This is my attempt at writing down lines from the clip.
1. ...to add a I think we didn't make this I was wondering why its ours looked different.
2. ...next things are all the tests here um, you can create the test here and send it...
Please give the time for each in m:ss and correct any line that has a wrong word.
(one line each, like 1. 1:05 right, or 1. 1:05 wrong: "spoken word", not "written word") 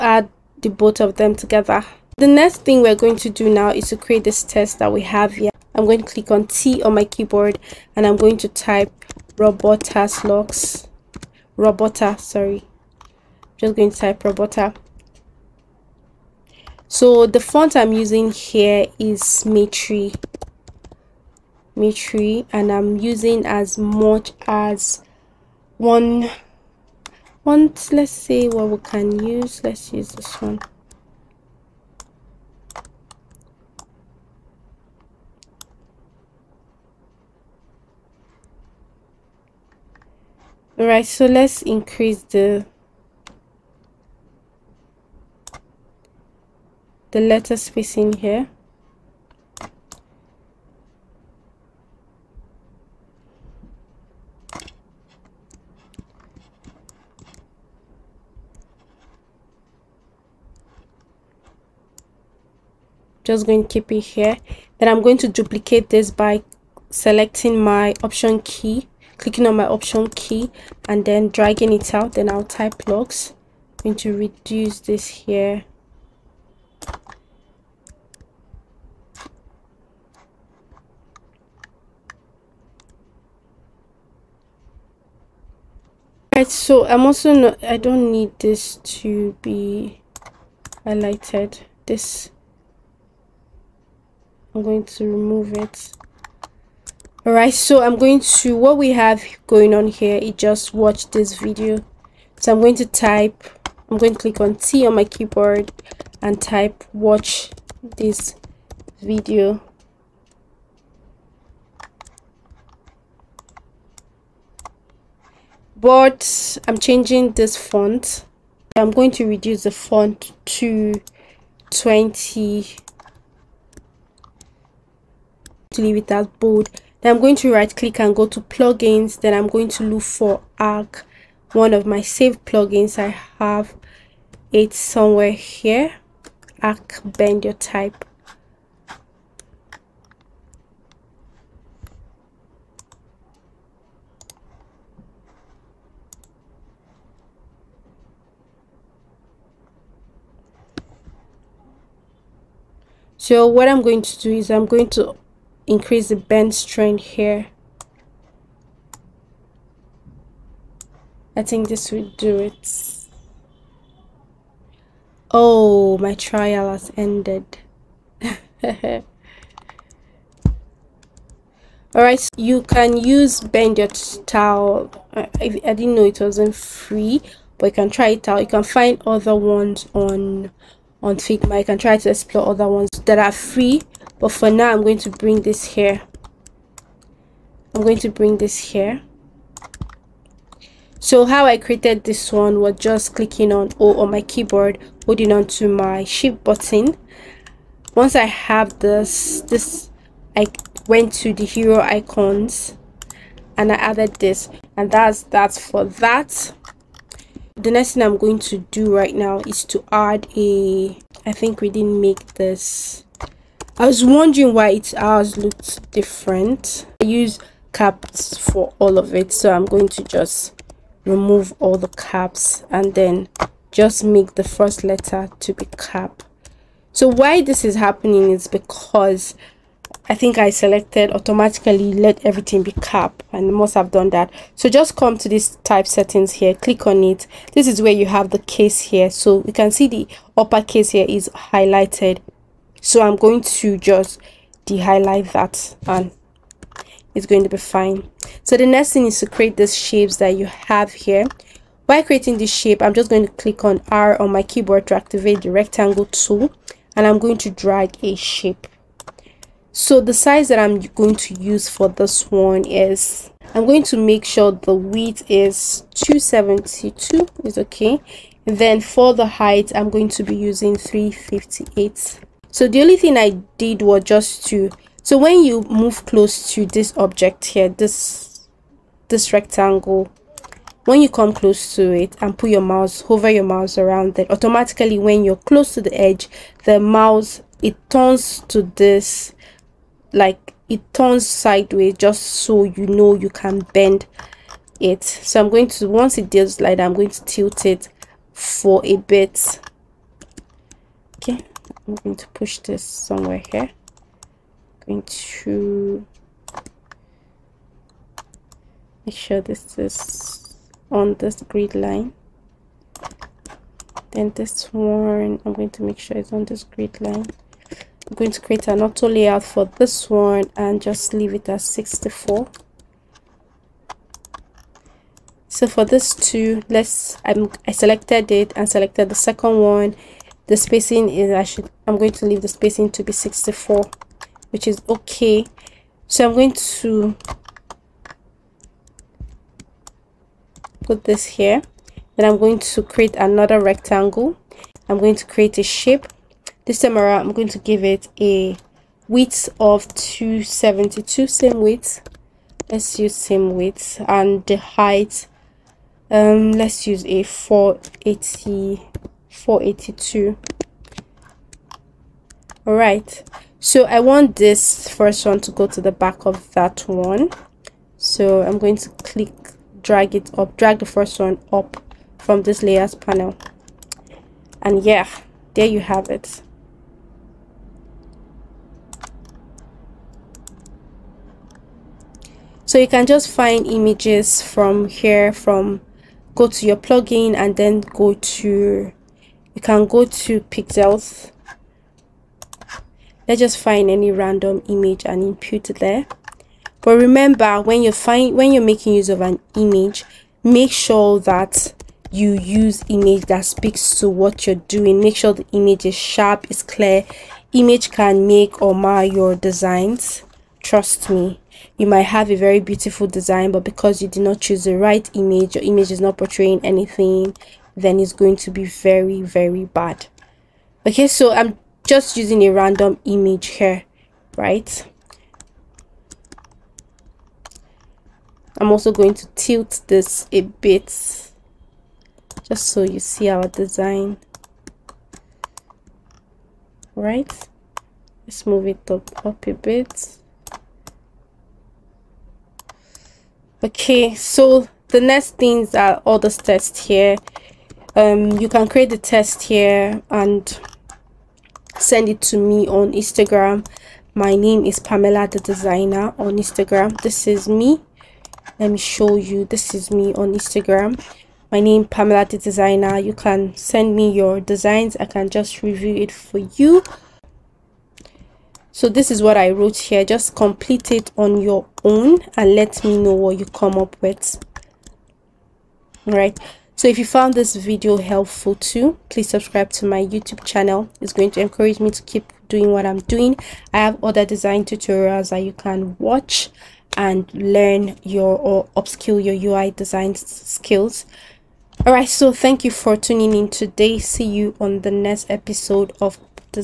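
1. 3:29 right
2. 7:24 right.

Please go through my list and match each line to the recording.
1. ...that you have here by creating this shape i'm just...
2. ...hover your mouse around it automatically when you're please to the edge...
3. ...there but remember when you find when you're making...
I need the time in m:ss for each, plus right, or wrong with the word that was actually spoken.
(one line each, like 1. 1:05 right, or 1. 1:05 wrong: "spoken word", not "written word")
1. 4:10 right
2. 4:43 wrong: "close", not "please"
3. 6:35 right.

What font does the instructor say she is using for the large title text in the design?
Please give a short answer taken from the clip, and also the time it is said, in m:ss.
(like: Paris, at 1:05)
Mitri, at 0:19.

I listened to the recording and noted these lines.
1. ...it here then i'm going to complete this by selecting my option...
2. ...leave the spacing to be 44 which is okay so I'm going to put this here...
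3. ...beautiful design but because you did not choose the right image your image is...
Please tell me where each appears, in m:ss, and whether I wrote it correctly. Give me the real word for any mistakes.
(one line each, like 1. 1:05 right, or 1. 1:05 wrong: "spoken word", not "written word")
1. 1:03 wrong: "duplicate", not "complete"
2. 5:32 wrong: "64", not "44"
3. 6:52 right.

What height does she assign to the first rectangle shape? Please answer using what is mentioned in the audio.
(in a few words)
358.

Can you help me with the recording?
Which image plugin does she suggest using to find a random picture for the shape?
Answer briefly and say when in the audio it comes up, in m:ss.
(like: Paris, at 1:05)
Pexels, at 6:30.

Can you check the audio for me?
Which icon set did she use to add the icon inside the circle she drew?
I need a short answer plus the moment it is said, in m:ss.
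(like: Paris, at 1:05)
Hero icons, at 3:21.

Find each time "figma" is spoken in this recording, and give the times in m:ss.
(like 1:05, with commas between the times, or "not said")
3:01.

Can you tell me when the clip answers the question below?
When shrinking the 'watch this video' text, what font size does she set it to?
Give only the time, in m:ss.
2:01.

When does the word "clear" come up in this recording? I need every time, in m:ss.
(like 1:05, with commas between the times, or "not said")
6:46.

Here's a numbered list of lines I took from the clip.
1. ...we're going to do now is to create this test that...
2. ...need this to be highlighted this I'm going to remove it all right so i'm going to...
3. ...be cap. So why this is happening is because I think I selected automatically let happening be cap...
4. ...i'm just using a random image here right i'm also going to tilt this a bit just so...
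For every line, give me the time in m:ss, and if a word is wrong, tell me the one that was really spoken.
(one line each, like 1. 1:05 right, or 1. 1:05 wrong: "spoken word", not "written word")
1. 0:02 right
2. 1:28 right
3. 3:45 wrong: "everything", not "happening"
4. 7:01 right.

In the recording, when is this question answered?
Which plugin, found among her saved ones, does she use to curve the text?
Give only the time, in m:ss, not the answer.
2:16.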